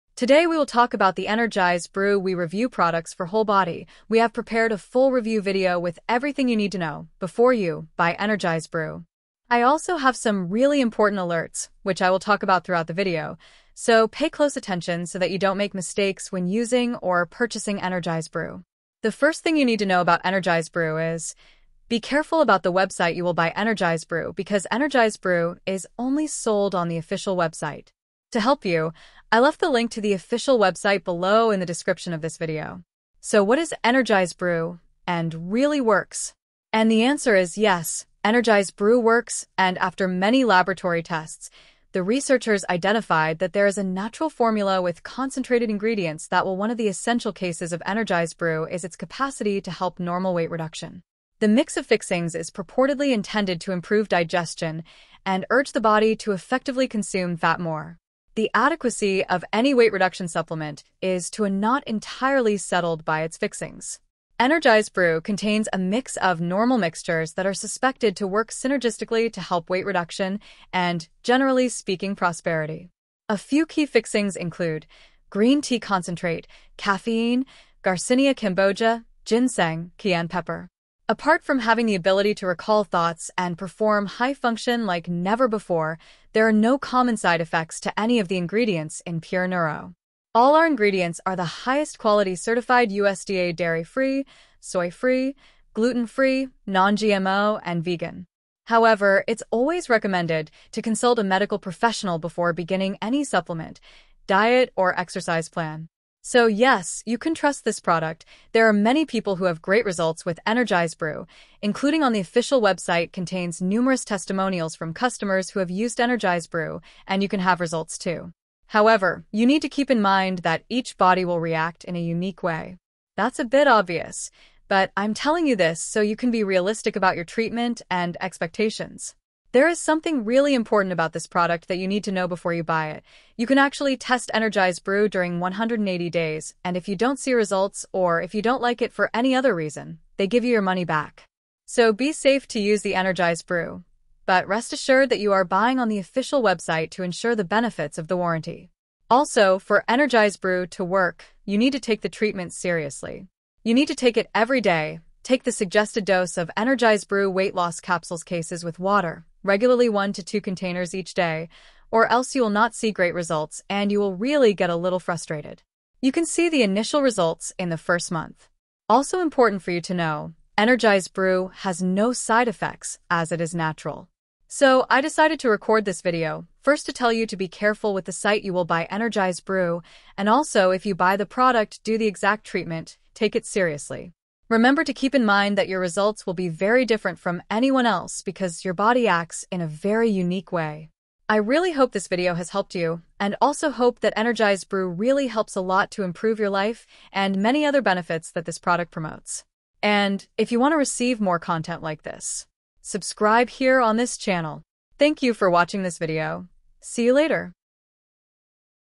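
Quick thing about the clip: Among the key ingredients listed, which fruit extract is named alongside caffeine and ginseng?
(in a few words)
Garcinia cambogia.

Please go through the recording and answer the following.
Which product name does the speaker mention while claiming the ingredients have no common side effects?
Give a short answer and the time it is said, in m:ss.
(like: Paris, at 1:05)
Pure Neuro, at 1:29.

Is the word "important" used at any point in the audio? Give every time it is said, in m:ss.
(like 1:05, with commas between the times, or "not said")
0:10, 2:10, 2:49.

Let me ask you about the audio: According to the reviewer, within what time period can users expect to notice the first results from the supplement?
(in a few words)
the first month.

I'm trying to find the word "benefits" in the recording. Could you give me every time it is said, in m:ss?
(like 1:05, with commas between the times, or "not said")
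2:27, 3:17.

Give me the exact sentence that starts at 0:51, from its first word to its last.
The mix of fixings is purportedly intended to improve digestion and urge the body to effectively consume fat more.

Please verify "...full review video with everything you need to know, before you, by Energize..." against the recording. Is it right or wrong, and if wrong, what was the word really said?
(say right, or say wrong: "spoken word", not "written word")
right.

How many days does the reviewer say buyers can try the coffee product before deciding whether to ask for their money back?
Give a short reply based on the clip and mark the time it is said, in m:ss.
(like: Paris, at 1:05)
180 days, at 2:15.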